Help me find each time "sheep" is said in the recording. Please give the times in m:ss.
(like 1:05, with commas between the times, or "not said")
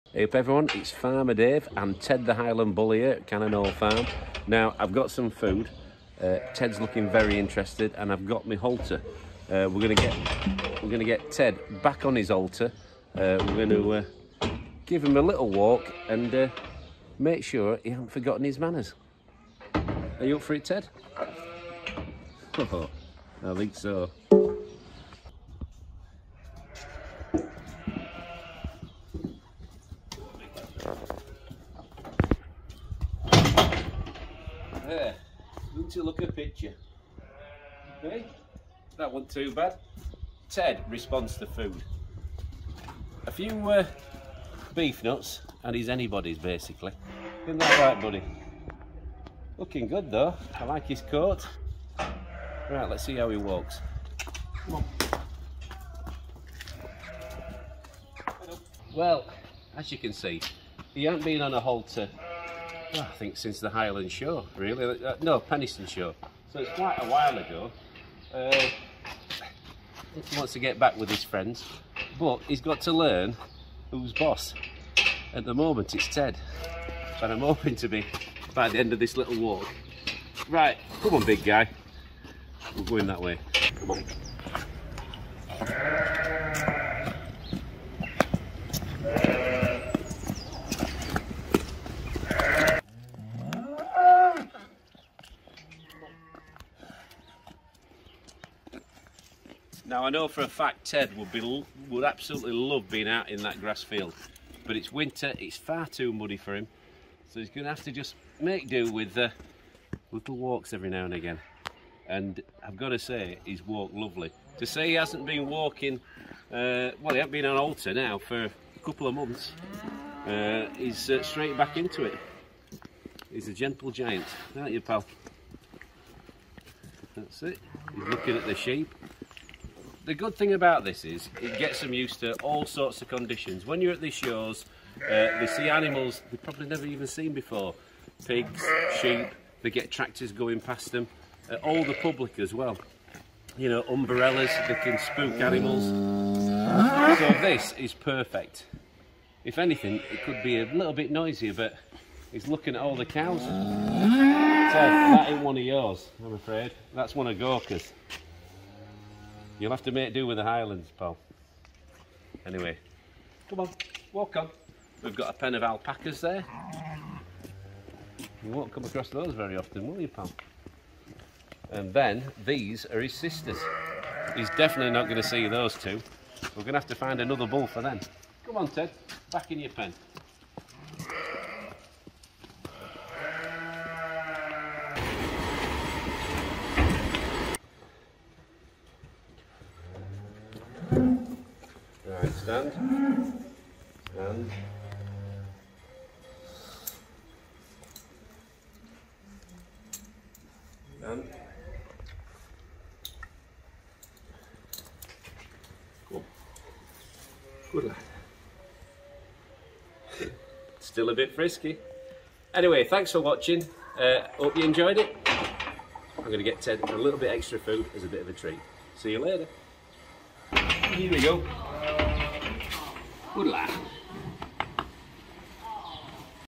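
2:08, 2:19.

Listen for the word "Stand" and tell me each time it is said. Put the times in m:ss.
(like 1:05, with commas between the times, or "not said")
3:12, 3:20.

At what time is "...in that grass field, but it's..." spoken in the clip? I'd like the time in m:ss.
1:43.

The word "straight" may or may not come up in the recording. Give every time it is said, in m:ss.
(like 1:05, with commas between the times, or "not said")
2:01.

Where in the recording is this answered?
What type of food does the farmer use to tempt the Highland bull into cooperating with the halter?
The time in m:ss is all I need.
0:44.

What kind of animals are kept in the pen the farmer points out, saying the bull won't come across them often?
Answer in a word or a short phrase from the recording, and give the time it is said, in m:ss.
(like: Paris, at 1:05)
Alpacas, at 2:45.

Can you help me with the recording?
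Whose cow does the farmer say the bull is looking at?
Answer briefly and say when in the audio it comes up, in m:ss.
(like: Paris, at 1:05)
Gorka, at 2:37.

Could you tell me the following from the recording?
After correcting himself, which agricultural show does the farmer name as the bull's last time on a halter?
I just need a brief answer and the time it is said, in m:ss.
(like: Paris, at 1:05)
Penistone Show, at 1:05.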